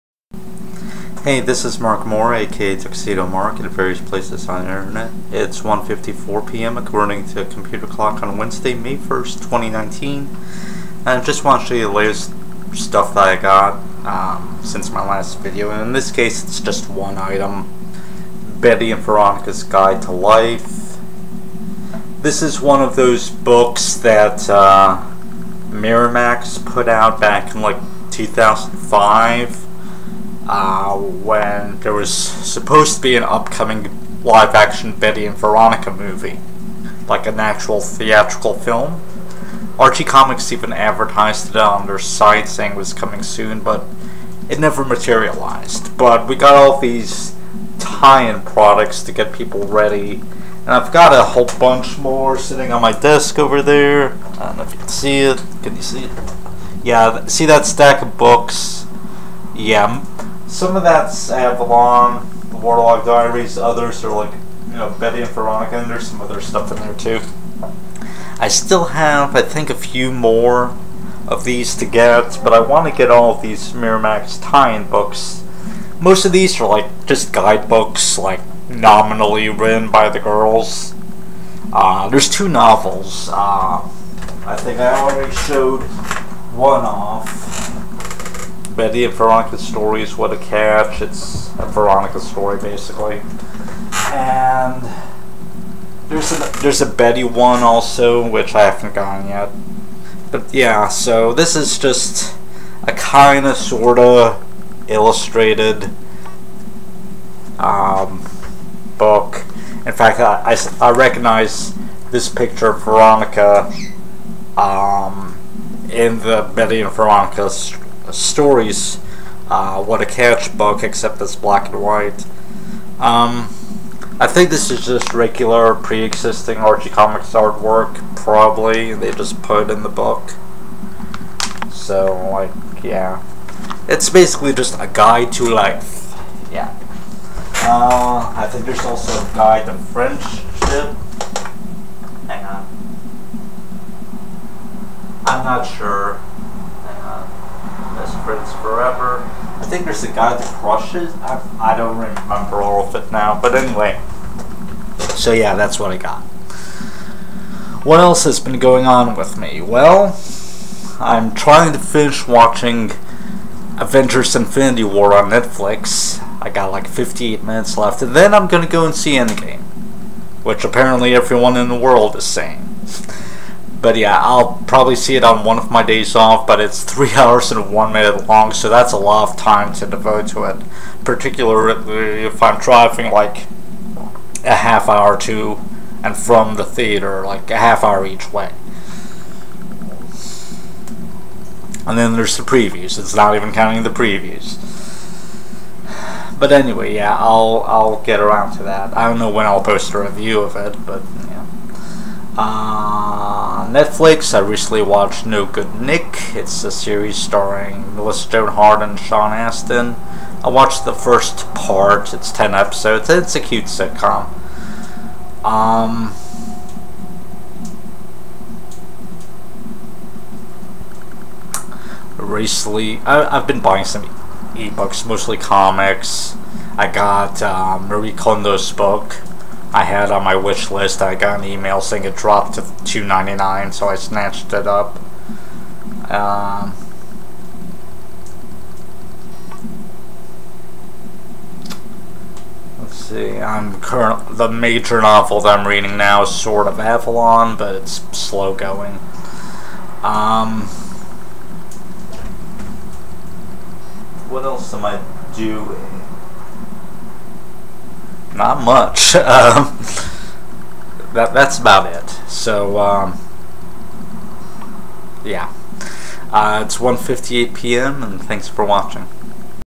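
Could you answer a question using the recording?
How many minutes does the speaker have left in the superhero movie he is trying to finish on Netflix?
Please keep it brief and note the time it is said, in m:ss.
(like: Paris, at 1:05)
58, at 2:46.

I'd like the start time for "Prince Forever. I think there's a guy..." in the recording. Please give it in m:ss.
2:28.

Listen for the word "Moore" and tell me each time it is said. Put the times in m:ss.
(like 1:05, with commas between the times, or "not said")
0:02.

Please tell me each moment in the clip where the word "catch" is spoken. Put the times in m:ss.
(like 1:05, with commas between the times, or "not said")
1:30, 2:00.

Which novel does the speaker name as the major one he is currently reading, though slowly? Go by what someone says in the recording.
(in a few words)
Sword of Avalon.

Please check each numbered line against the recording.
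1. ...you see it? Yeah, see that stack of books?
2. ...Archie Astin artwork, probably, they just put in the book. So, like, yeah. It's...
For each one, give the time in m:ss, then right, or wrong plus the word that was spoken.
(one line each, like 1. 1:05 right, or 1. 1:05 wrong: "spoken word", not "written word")
1. 0:55 right
2. 2:06 wrong: "Comics", not "Astin".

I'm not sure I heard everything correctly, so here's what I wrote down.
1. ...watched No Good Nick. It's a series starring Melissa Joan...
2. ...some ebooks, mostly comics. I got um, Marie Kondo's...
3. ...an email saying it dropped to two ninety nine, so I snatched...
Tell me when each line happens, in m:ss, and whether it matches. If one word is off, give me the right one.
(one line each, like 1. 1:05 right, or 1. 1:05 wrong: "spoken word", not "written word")
1. 3:24 right
2. 3:43 right
3. 3:51 right.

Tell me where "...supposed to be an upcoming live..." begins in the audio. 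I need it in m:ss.
0:32.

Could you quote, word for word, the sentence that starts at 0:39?
Archie Comics even advertised it on their site saying it was coming soon, but it never materialized.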